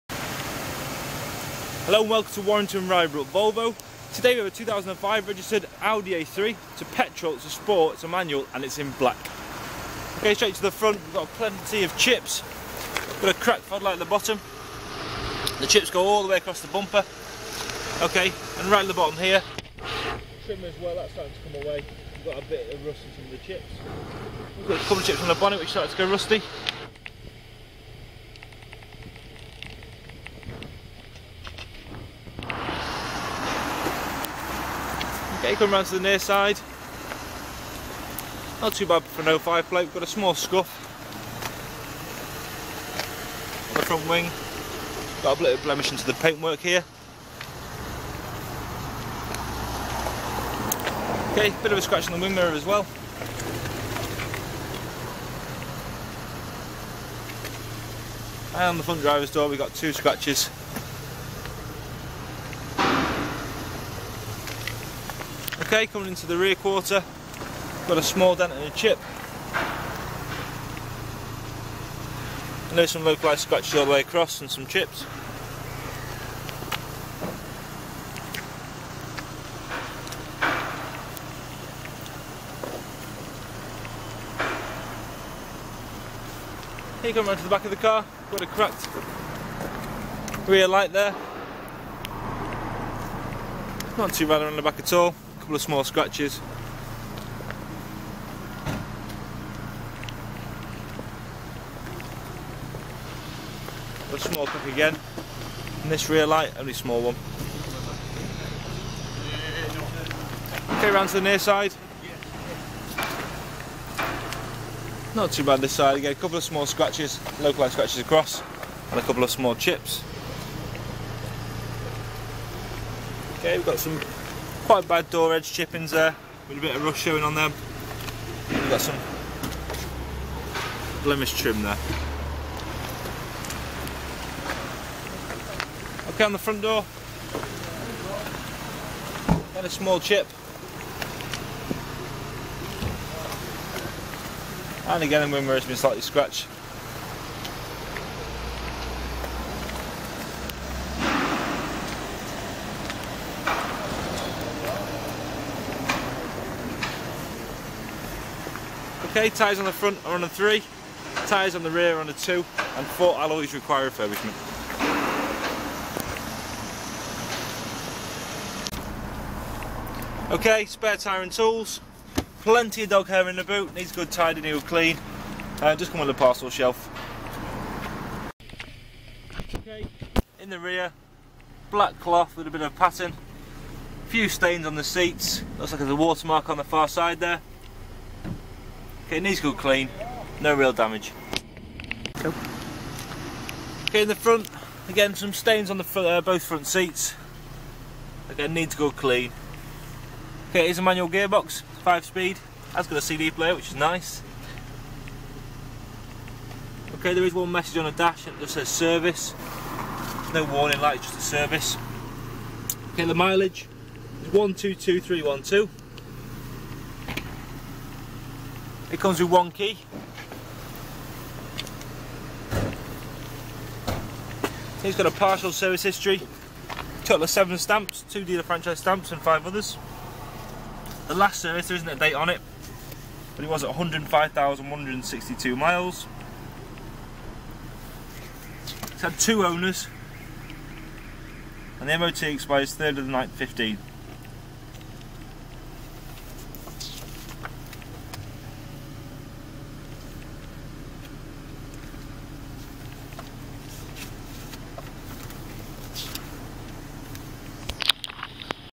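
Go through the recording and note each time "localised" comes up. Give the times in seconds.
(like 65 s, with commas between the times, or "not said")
73 s, 117 s.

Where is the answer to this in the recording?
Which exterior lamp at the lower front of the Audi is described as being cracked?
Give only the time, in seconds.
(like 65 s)
13 s.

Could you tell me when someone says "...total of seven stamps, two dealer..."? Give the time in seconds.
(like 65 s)
227 s.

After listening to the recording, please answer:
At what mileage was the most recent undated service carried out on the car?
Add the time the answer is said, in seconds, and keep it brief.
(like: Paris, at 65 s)
105,162 miles, at 233 s.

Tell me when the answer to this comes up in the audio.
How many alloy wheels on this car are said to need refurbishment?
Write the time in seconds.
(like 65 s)
162 s.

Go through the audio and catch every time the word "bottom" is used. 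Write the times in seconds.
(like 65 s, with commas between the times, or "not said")
14 s, 18 s.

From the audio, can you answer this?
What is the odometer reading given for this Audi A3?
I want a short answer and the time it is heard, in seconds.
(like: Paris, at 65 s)
122312, at 214 s.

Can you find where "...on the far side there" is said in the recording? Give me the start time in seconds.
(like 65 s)
186 s.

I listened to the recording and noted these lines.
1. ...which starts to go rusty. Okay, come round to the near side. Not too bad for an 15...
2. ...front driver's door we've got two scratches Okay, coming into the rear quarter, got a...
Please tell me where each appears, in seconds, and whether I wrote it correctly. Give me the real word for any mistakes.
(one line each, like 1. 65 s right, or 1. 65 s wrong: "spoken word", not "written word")
1. 25 s wrong: "05", not "15"
2. 58 s right.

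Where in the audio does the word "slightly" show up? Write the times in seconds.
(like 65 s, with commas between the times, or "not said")
145 s.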